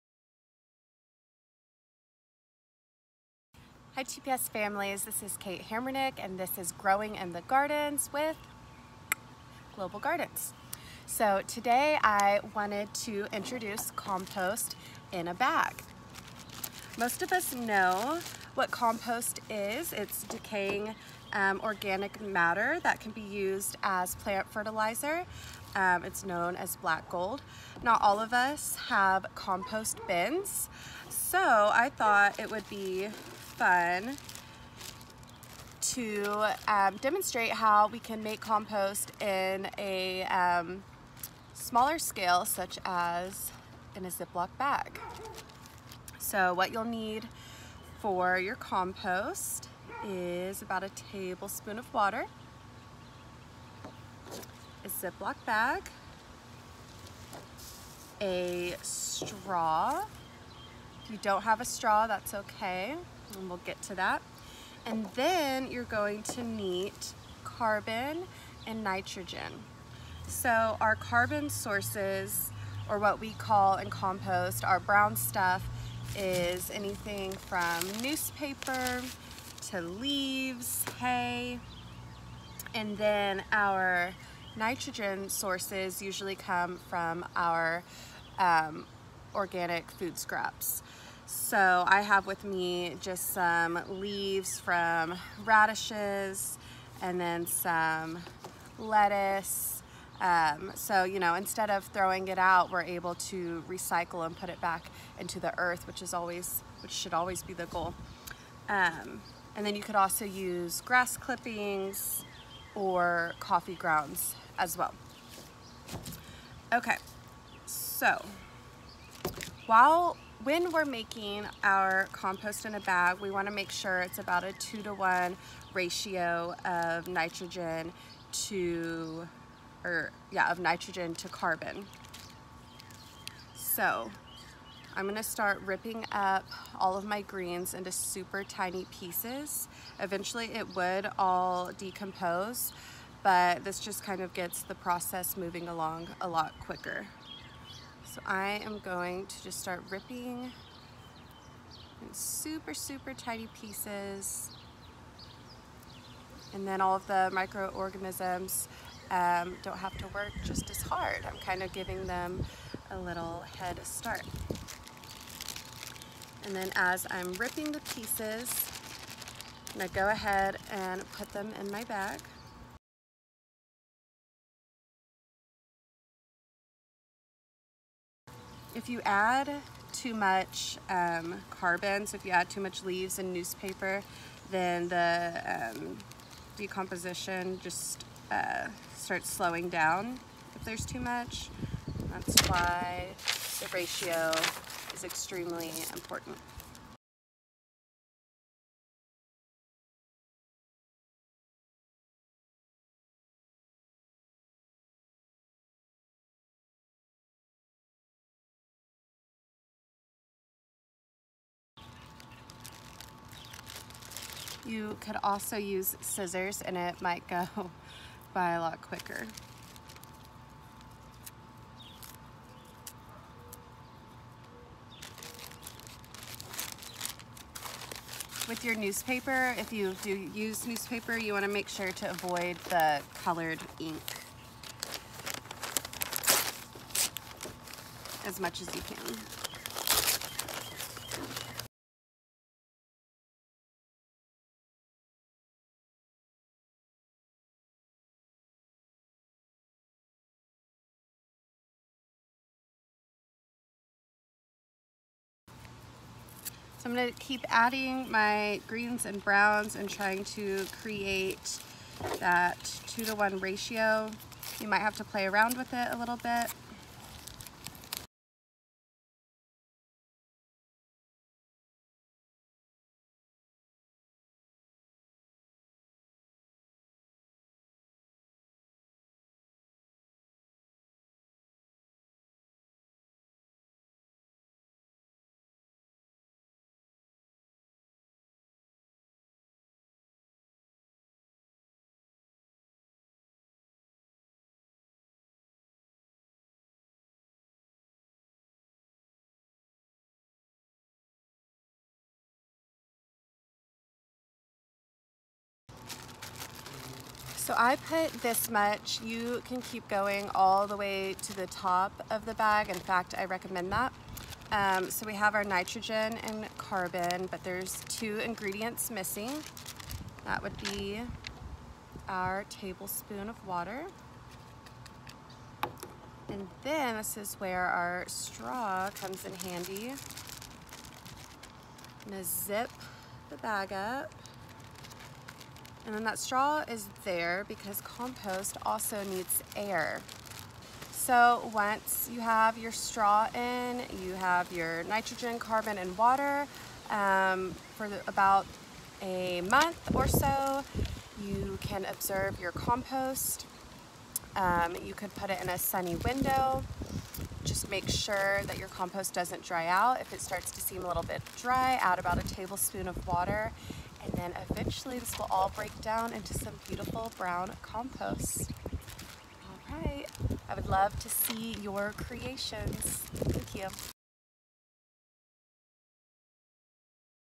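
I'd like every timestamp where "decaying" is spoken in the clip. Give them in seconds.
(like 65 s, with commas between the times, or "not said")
20 s.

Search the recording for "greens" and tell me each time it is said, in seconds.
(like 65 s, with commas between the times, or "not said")
137 s, 258 s.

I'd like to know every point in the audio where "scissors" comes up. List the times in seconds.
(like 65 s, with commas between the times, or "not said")
216 s.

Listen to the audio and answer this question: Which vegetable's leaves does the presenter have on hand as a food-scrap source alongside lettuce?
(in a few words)
radishes.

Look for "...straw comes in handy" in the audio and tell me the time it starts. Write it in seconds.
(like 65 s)
328 s.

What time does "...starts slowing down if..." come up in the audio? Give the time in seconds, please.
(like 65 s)
188 s.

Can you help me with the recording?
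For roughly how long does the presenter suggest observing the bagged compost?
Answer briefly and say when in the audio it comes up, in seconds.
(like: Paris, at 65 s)
about a month, at 348 s.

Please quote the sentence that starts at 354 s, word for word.
Um, you could put it in a sunny window.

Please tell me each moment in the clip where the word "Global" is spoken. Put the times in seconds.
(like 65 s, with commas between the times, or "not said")
9 s.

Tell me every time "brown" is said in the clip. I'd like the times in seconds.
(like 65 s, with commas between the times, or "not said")
74 s, 259 s, 367 s.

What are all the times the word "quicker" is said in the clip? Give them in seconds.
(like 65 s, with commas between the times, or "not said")
146 s, 218 s.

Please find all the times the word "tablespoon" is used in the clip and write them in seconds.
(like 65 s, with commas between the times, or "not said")
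51 s, 322 s, 362 s.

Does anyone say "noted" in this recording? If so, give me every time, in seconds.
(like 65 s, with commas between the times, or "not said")
not said.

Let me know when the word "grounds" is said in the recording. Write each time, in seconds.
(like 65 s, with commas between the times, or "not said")
113 s.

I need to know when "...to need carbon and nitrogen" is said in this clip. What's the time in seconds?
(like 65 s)
66 s.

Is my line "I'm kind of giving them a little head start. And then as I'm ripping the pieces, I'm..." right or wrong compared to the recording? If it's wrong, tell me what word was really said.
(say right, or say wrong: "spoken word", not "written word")
right.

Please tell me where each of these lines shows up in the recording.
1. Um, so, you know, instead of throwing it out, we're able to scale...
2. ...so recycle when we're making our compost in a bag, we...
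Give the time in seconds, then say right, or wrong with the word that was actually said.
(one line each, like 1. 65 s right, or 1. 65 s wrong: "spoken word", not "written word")
1. 100 s wrong: "recycle", not "scale"
2. 117 s wrong: "while", not "recycle".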